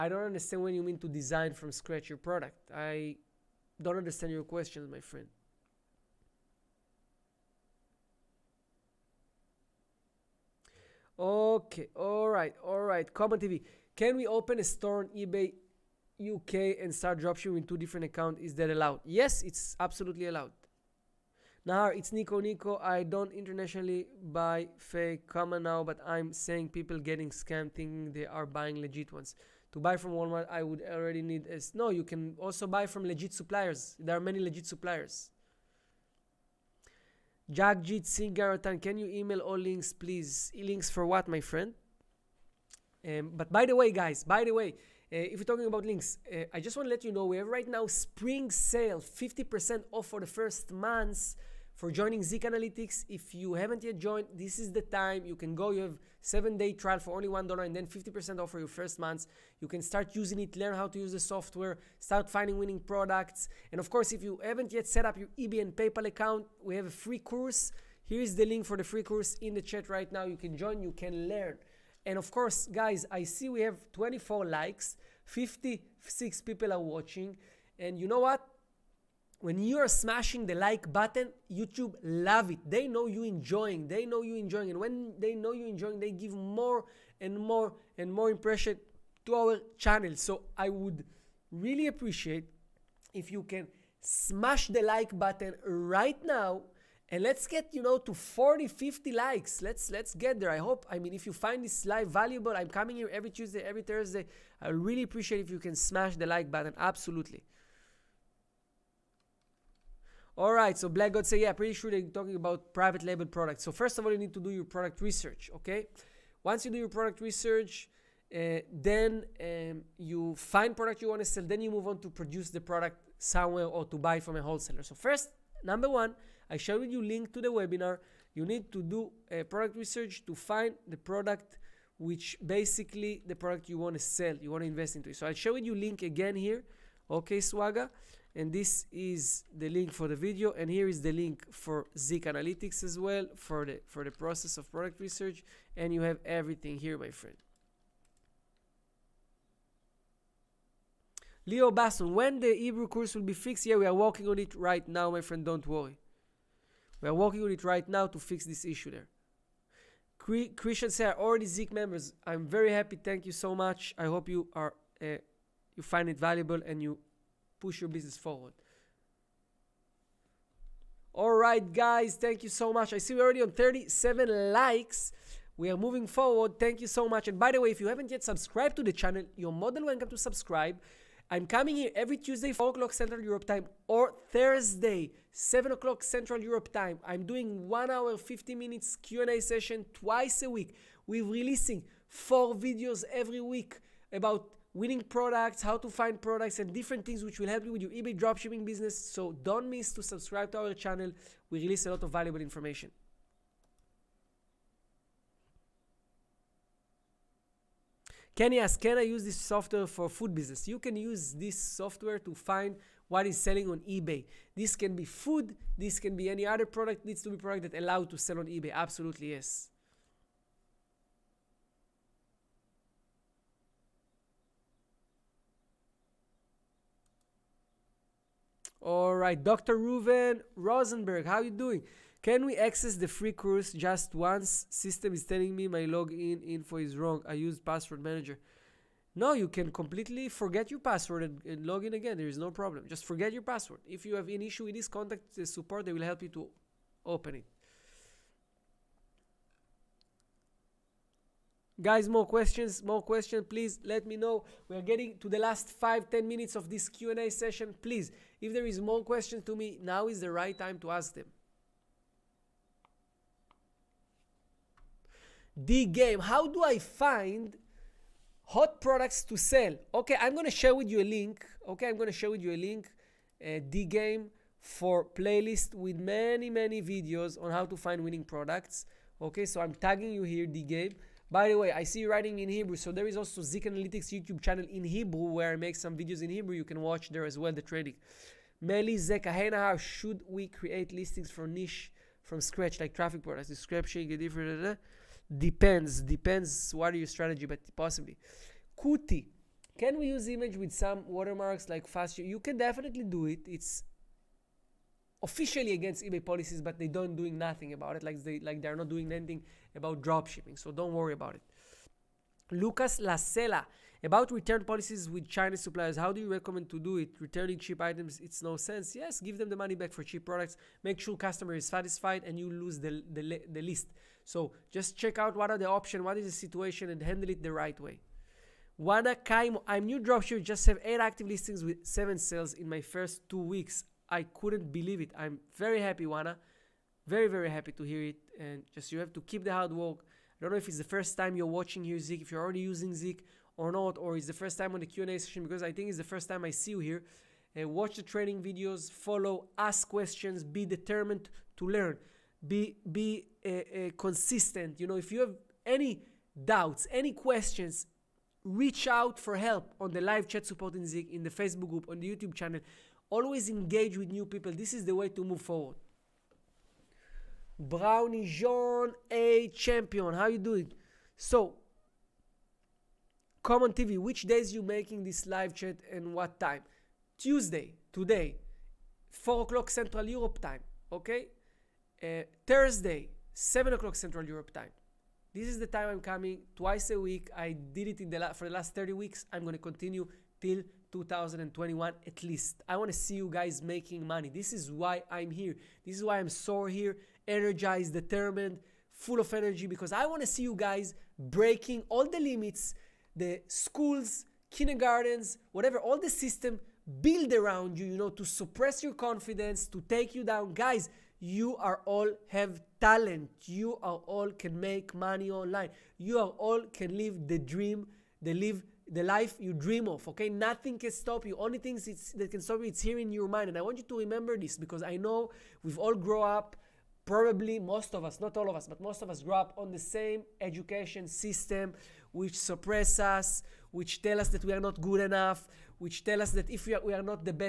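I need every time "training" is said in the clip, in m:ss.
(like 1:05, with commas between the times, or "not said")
4:47, 5:48.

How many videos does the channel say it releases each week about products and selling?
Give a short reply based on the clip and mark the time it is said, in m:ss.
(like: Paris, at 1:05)
4, at 3:12.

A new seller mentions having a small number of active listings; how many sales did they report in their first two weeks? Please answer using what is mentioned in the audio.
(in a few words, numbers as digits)
7.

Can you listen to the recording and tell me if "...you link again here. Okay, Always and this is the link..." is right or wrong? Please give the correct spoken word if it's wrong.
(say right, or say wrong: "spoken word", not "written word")
wrong: "Swaga", not "Always".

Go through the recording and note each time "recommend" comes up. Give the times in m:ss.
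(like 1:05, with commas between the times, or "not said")
5:16.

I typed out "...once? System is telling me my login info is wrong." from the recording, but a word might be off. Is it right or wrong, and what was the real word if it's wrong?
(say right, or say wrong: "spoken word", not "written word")
right.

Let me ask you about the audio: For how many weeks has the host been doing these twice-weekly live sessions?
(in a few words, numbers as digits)
30.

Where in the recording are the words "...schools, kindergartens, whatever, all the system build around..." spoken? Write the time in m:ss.
6:43.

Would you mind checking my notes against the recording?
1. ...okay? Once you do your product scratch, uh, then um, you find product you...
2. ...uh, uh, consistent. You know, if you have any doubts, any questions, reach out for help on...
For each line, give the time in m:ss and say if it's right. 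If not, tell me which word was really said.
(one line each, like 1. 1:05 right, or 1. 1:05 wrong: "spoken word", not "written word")
1. 1:55 wrong: "research", not "scratch"
2. 5:53 right.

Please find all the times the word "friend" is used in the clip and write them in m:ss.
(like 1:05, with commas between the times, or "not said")
0:05, 0:41, 2:27, 2:35.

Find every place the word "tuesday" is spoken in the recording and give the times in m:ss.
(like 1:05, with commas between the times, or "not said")
1:43, 3:02, 6:17.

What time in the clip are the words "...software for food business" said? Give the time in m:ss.
3:29.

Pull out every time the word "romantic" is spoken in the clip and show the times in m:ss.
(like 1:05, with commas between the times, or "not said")
not said.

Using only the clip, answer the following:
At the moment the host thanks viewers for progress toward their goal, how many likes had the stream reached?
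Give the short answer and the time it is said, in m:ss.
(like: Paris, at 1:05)
37, at 2:53.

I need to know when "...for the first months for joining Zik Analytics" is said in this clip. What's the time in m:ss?
0:50.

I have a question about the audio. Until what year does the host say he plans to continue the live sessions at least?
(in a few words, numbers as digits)
2021.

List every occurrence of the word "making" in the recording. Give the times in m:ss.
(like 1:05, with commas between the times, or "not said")
6:14, 6:33.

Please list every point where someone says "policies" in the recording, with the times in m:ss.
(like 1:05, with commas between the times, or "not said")
5:06, 5:14.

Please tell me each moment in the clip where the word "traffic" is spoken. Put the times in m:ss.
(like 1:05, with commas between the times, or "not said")
4:52.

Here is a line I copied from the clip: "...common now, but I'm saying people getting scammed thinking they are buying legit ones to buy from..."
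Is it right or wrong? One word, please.
right.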